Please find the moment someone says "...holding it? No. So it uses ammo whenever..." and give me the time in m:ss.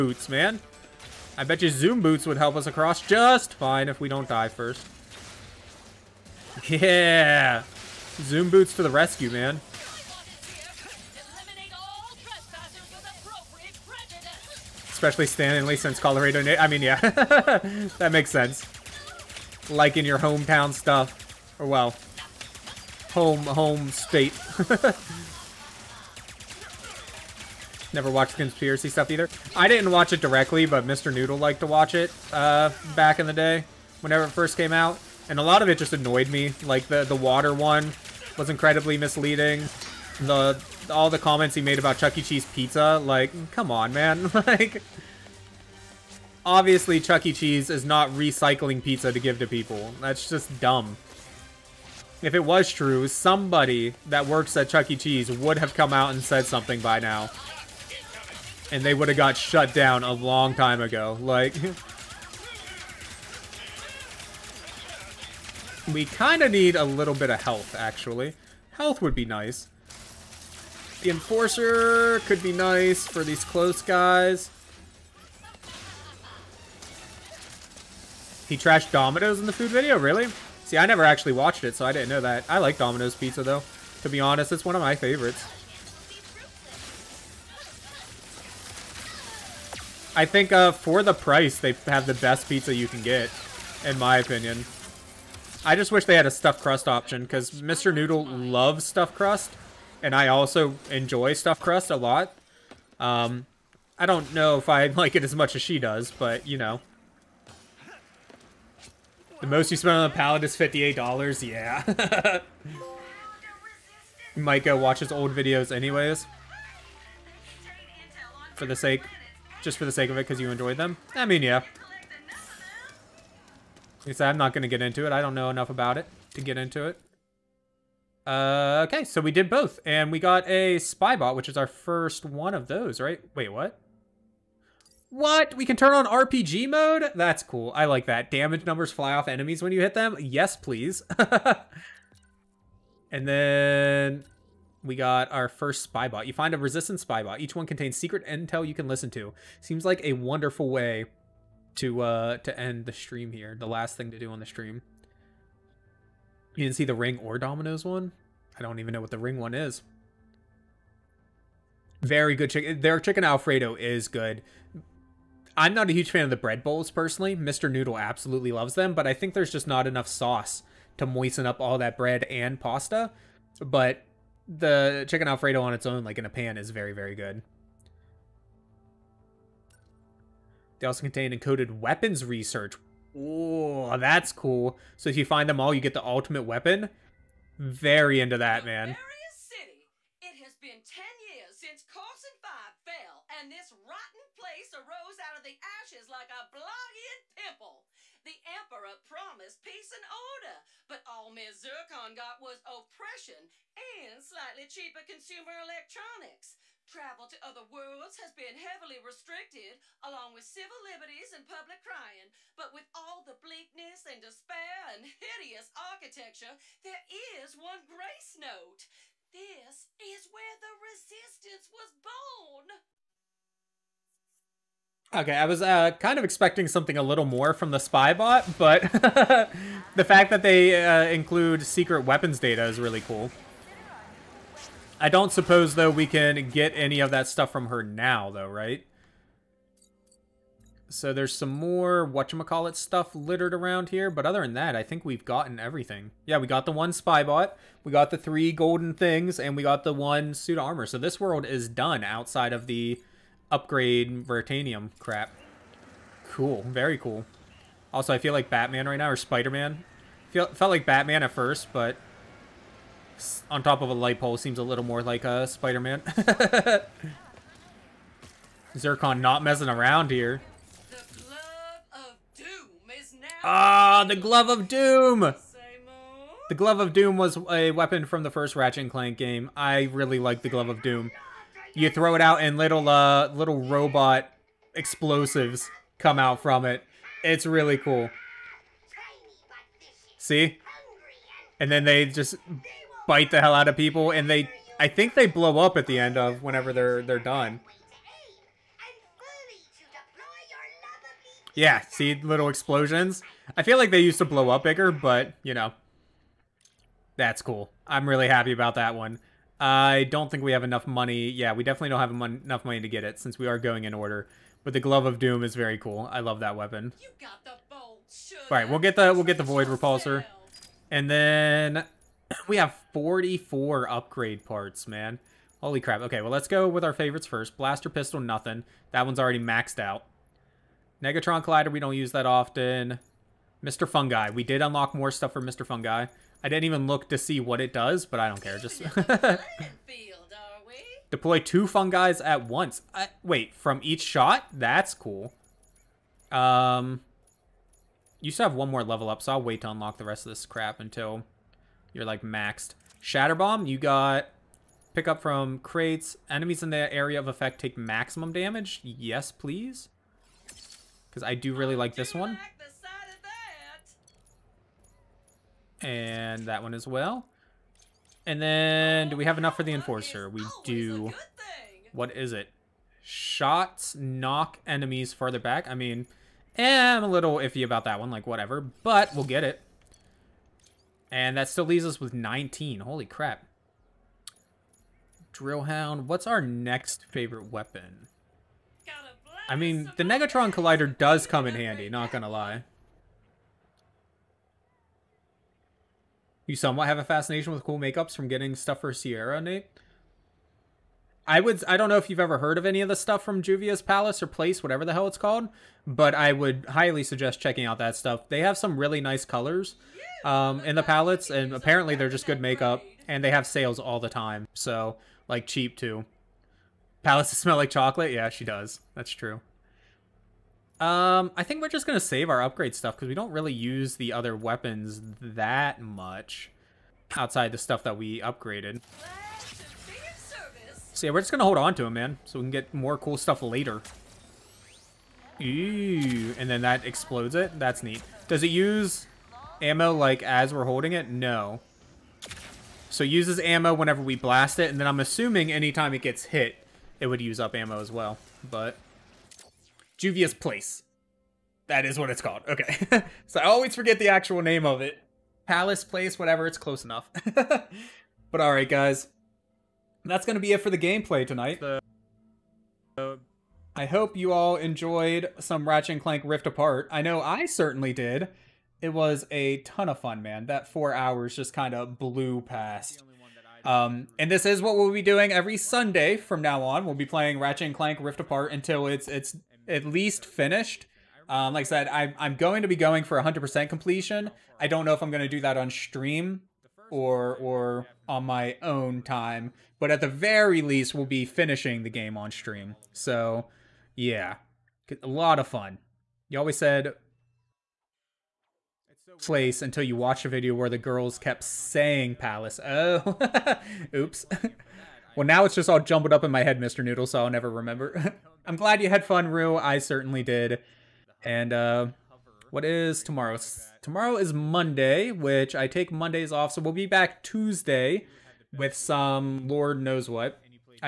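7:20.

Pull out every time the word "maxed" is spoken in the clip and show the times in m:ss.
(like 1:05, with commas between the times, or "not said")
5:29, 5:52.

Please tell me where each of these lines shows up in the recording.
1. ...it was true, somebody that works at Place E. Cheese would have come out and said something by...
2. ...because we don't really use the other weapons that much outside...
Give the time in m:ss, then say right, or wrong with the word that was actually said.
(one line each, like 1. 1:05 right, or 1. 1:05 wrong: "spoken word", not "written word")
1. 0:52 wrong: "Chuck", not "Place"
2. 7:02 right.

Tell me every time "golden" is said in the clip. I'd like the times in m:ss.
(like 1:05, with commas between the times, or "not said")
4:08.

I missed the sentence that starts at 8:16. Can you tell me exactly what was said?
You always said place until you watch a video where the girls kept saying palace.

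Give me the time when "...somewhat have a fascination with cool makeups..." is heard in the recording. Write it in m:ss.
6:36.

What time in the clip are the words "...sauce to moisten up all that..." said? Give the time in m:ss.
2:50.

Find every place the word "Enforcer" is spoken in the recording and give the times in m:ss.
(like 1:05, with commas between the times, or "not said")
1:11, 6:09.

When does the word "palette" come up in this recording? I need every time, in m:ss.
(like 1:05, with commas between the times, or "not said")
1:50, 6:50.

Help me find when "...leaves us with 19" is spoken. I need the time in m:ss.
6:21.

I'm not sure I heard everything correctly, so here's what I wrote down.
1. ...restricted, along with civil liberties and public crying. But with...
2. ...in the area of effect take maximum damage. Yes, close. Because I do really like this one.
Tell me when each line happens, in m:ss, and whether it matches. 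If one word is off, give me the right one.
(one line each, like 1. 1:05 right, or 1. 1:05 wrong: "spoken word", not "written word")
1. 3:28 right
2. 5:56 wrong: "please", not "close".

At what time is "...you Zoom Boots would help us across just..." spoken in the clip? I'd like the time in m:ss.
0:01.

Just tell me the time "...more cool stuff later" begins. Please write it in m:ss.
7:12.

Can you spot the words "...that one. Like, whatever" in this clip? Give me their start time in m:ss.
6:17.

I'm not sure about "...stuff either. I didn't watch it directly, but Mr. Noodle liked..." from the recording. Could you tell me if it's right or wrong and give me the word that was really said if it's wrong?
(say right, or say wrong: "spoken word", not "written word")
right.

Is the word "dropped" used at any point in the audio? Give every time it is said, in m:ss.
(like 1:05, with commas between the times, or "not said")
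not said.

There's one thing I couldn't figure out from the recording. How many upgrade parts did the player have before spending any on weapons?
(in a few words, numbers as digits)
44.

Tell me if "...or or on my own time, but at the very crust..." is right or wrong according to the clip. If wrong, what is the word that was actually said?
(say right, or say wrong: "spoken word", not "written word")
wrong: "least", not "crust".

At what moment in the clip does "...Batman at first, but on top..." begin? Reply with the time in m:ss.
4:20.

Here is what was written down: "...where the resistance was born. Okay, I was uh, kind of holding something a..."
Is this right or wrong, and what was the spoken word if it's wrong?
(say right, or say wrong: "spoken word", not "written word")
wrong: "expecting", not "holding".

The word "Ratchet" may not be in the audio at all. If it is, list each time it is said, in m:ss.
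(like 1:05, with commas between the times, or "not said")
4:38, 7:45, 7:57.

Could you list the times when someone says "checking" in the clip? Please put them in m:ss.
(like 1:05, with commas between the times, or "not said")
6:47.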